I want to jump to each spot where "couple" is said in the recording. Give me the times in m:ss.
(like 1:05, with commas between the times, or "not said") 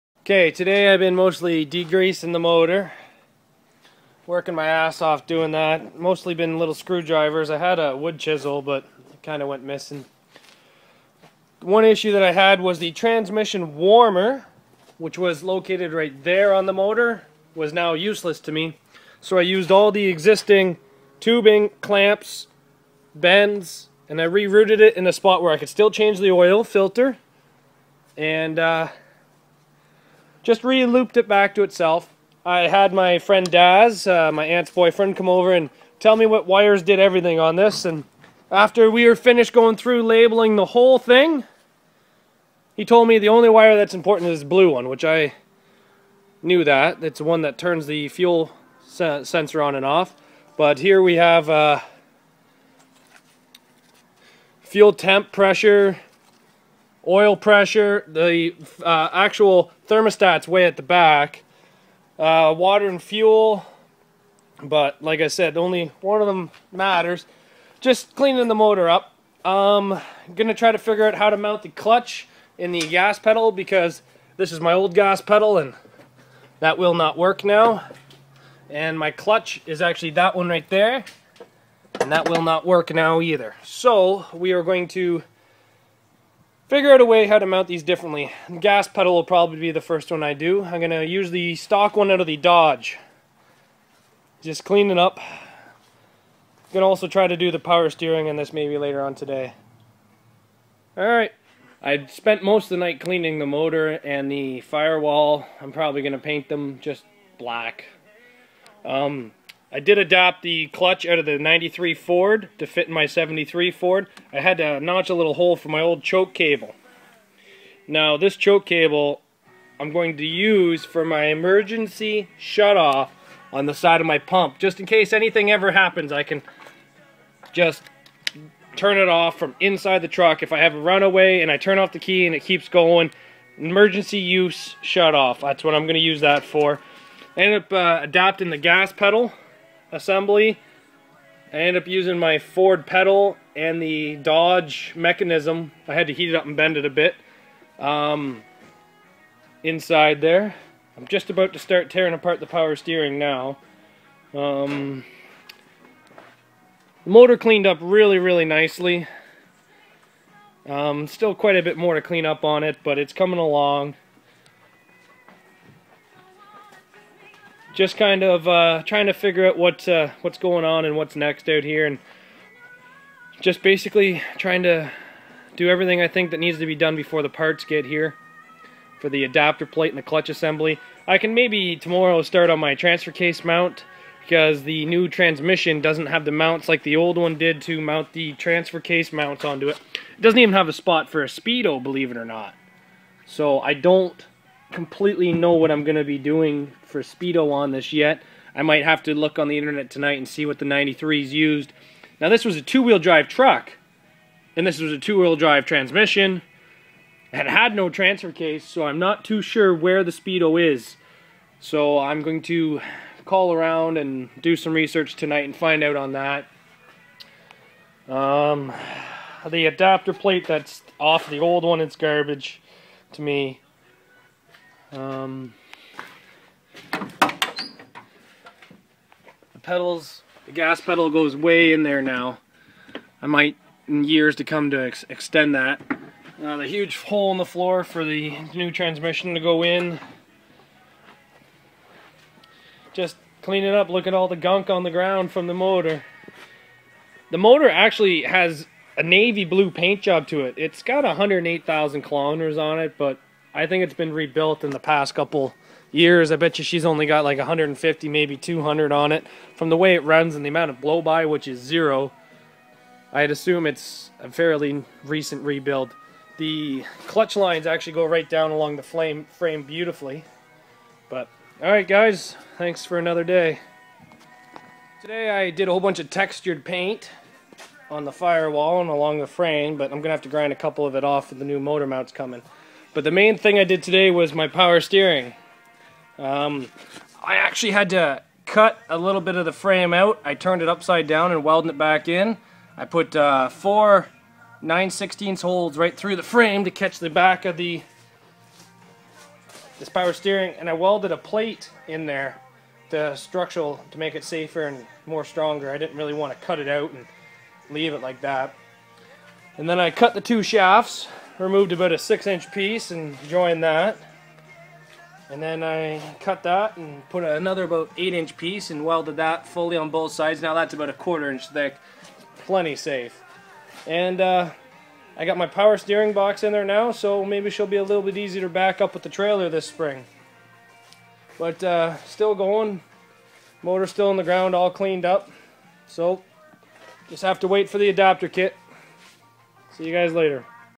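4:15, 4:40.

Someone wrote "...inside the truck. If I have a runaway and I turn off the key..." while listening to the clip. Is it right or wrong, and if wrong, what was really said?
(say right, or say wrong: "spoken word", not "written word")
right.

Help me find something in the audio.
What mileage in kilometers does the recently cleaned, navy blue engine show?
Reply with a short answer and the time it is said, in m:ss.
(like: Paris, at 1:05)
108,000 kilometers, at 4:11.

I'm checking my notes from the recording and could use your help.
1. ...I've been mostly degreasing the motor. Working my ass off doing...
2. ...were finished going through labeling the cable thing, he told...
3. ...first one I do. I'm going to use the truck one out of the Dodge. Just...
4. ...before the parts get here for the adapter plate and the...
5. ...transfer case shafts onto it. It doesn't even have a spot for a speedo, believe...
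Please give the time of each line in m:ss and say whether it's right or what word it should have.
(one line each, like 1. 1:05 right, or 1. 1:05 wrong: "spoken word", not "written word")
1. 0:00 right
2. 0:39 wrong: "whole", not "cable"
3. 1:29 wrong: "stock", not "truck"
4. 2:56 right
5. 3:08 wrong: "mounts", not "shafts".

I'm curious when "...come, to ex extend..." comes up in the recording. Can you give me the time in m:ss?
3:54.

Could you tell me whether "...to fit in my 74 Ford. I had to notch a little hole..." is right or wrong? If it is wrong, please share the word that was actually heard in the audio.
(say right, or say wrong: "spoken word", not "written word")
wrong: "73", not "74".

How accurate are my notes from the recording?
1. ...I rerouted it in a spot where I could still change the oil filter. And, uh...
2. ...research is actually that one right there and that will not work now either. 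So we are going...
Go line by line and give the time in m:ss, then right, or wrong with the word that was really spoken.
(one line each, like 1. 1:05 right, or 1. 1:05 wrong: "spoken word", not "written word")
1. 0:24 right
2. 1:19 wrong: "clutch", not "research".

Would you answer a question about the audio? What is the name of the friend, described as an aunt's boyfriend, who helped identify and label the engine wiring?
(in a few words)
Daz.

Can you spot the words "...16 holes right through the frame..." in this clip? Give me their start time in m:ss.
4:54.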